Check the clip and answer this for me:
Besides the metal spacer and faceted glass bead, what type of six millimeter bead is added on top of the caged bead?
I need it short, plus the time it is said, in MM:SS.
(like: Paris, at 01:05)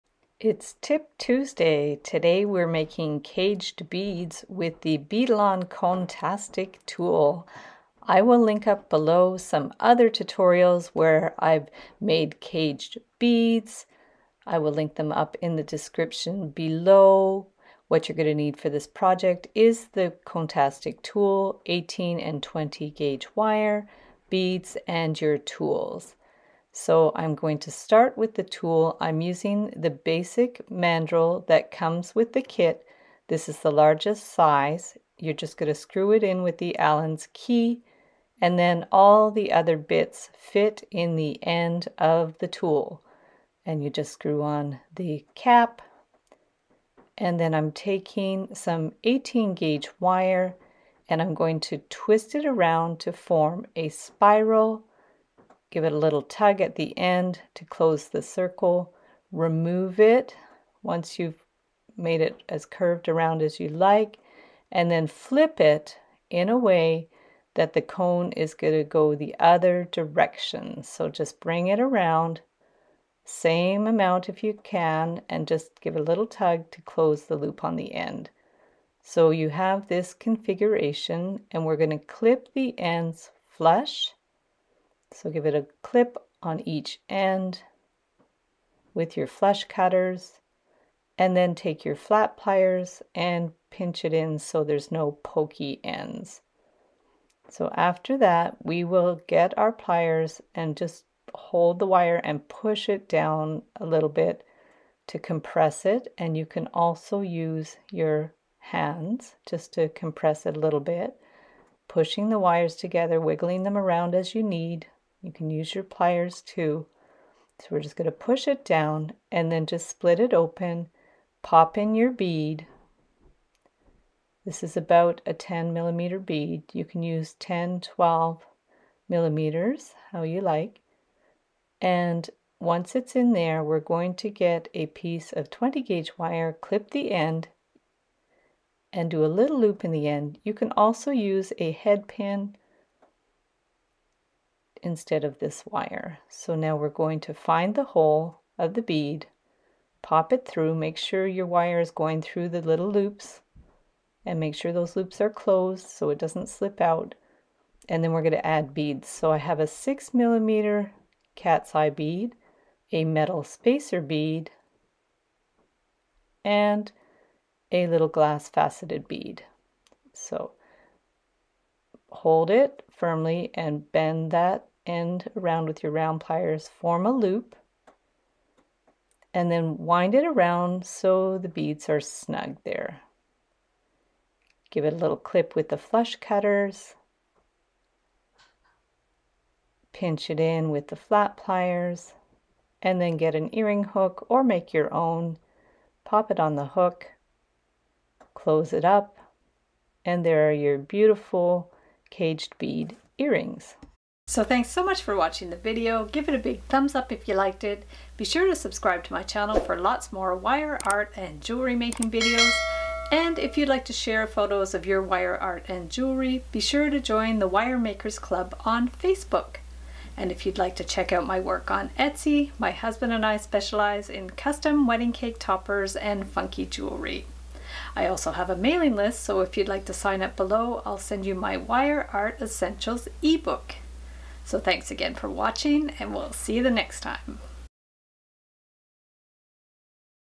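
cat's eye bead, at 02:41.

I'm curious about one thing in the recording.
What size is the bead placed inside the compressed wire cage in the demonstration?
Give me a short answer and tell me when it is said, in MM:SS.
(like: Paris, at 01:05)
10 millimeter, at 02:05.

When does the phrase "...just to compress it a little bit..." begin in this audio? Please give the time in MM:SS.
01:49.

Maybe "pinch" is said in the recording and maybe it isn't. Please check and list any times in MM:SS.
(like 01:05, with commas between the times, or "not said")
01:33, 03:09.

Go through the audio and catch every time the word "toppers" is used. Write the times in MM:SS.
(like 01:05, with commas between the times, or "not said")
03:45.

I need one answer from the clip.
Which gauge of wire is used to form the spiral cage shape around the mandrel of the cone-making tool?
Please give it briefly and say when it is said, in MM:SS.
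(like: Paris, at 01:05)
18 gauge, at 00:49.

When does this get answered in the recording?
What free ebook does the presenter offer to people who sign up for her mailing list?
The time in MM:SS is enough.
03:51.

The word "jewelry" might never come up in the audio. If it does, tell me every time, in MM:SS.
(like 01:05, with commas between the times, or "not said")
03:31, 03:35, 03:46.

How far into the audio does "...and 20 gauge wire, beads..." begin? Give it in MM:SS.
00:22.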